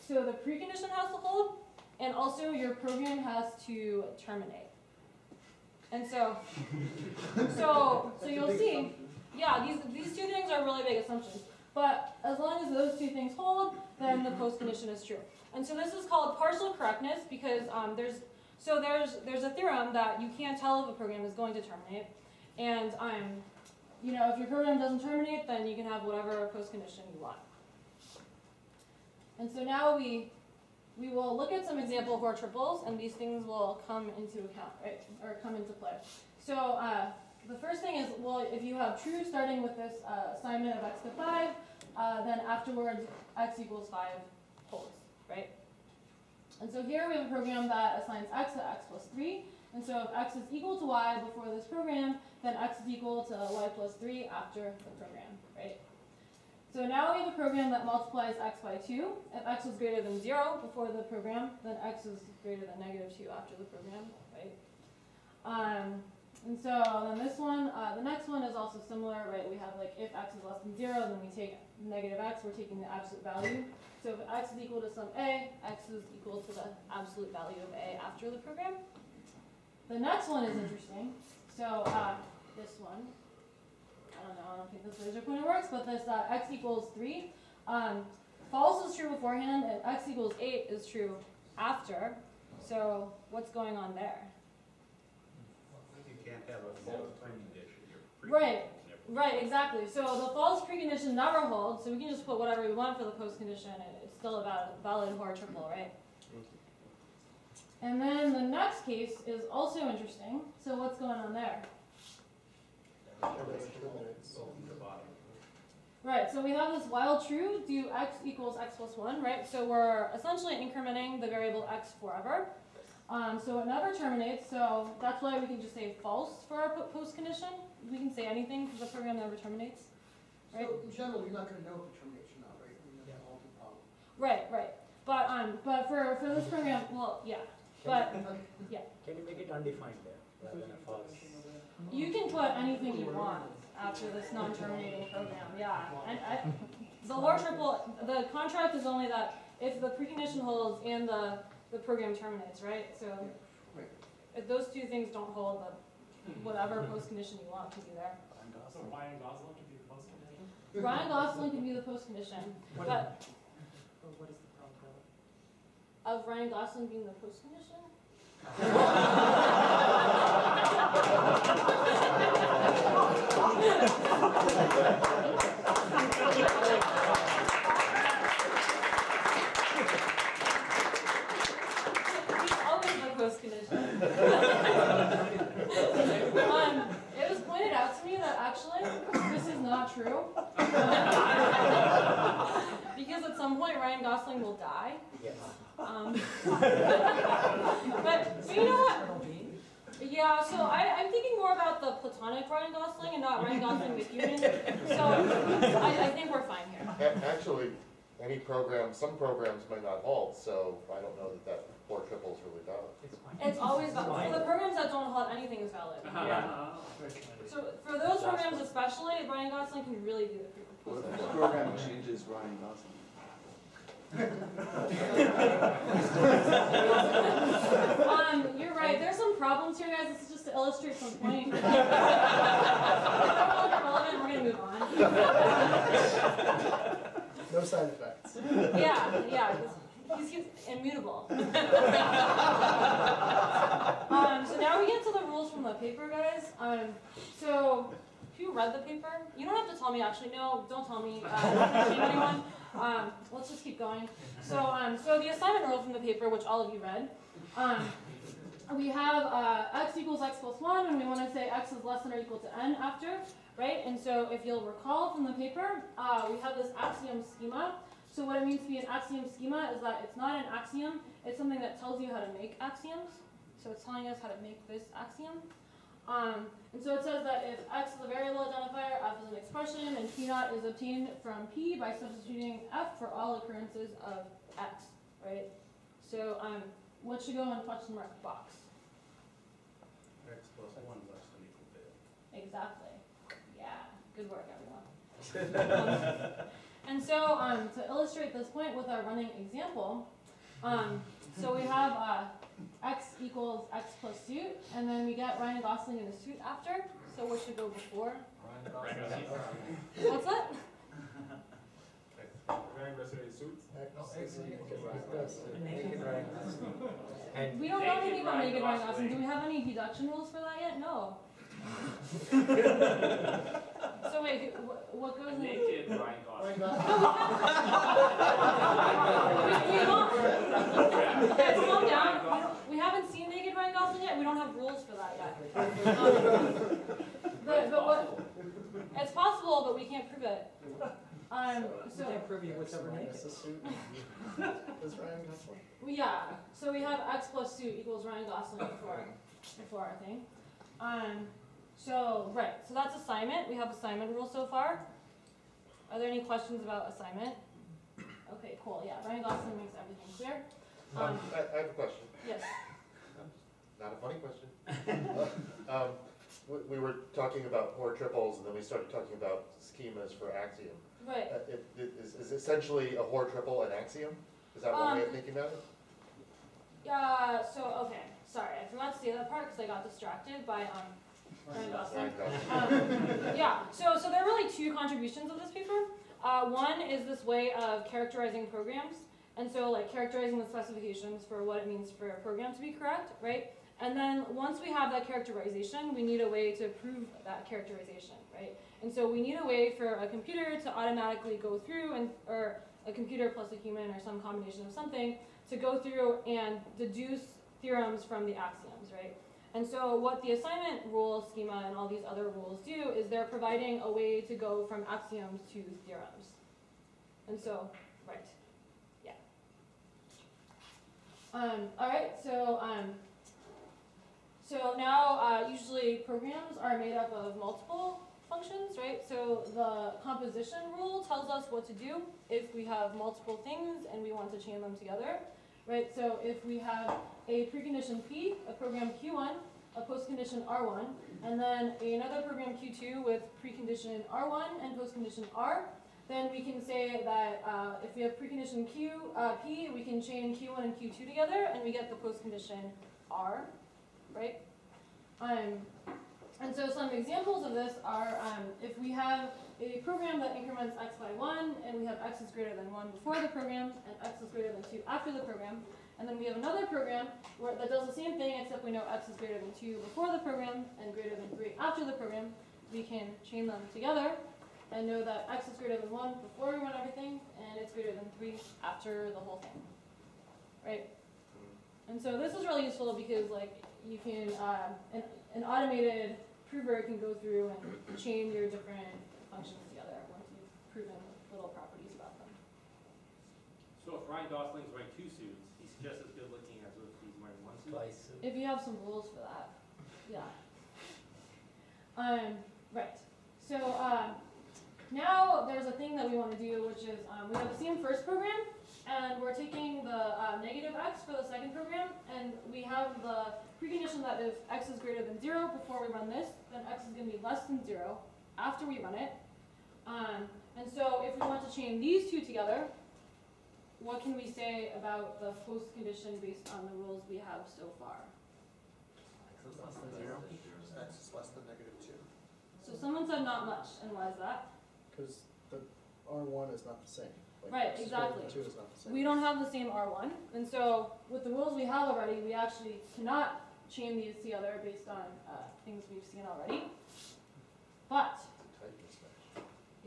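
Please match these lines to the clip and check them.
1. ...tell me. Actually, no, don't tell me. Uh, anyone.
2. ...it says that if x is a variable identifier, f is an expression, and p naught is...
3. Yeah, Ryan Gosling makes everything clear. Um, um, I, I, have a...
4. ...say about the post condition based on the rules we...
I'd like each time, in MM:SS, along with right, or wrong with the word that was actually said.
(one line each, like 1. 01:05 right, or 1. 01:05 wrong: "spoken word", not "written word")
1. 04:09 right
2. 04:36 right
3. 05:58 right
4. 08:44 right.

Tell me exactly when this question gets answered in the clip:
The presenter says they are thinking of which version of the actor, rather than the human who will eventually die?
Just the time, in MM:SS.
03:21.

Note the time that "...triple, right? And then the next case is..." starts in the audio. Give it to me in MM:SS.
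01:45.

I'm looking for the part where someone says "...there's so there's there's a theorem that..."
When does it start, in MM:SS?
00:17.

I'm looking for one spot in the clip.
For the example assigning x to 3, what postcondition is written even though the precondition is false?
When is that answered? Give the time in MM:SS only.
01:29.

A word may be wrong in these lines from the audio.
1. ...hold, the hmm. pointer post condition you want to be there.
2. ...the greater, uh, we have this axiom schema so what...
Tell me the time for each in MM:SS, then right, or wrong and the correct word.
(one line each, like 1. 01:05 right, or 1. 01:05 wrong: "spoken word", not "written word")
1. 02:35 wrong: "whatever", not "pointer"
2. 04:25 wrong: "paper", not "greater".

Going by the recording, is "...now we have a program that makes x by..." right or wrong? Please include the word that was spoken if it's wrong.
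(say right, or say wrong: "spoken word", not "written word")
wrong: "multiplies", not "makes".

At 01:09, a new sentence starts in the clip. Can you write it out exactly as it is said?
We have like if x is less than zero, then we take negative x, we're taking the absolute value.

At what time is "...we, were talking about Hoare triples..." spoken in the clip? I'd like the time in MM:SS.
06:06.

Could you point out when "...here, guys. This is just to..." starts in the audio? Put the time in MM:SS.
03:49.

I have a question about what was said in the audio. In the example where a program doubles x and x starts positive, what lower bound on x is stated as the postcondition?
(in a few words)
Negative 2.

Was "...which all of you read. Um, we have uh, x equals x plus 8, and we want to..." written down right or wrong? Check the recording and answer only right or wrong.
wrong.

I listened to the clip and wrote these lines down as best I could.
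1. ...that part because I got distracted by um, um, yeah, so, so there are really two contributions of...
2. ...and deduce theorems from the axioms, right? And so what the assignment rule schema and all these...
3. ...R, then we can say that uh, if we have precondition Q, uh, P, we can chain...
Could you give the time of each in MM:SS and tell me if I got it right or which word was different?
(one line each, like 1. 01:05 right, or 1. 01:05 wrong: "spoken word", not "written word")
1. 06:19 right
2. 06:46 right
3. 07:25 right.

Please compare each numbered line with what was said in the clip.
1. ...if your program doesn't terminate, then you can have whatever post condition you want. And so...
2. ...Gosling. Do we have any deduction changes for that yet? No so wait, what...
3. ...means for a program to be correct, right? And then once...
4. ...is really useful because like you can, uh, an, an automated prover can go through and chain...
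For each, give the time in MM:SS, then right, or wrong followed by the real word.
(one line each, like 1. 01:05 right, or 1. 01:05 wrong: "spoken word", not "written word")
1. 00:24 right
2. 05:18 wrong: "rules", not "changes"
3. 06:31 right
4. 08:02 right.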